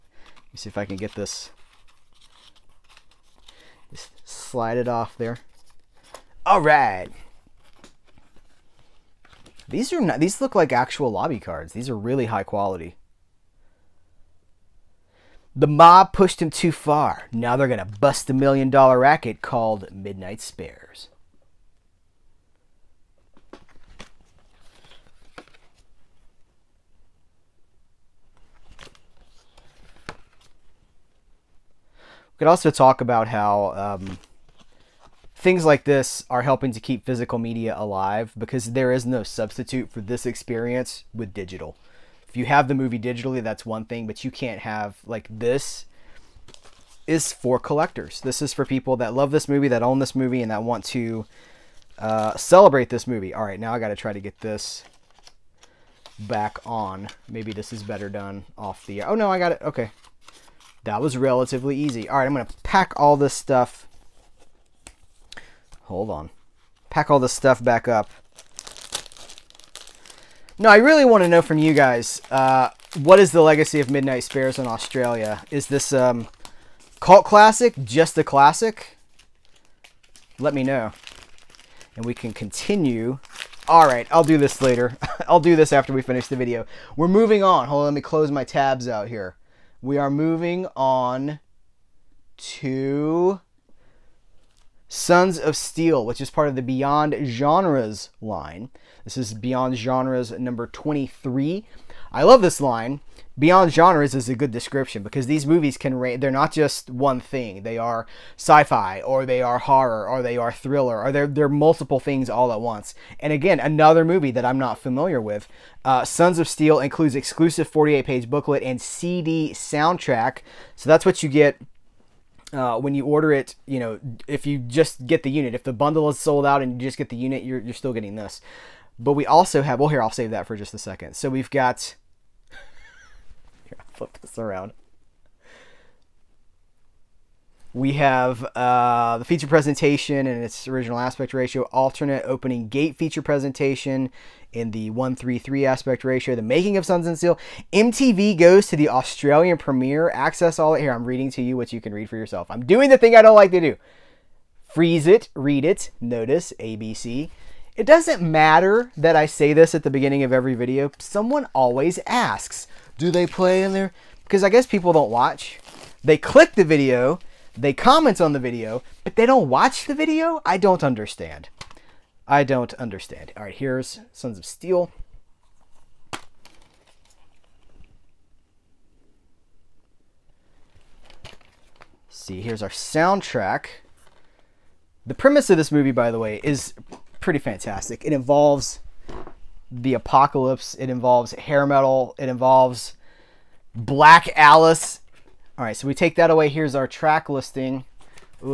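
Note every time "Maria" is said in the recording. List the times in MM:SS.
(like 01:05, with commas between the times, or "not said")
not said.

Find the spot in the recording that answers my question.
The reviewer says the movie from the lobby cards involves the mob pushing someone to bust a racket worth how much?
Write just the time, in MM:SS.
00:18.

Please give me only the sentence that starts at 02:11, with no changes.
So we've got flip this around.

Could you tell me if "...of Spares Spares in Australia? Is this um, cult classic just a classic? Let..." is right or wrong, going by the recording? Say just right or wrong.
wrong.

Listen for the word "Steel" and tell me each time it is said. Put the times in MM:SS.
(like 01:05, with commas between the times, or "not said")
01:35, 01:56, 02:27, 02:54.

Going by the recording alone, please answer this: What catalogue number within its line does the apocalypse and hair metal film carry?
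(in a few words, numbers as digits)
23.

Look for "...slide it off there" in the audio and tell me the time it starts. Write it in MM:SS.
00:04.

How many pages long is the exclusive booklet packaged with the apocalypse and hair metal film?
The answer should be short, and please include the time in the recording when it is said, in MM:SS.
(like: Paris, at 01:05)
48, at 01:57.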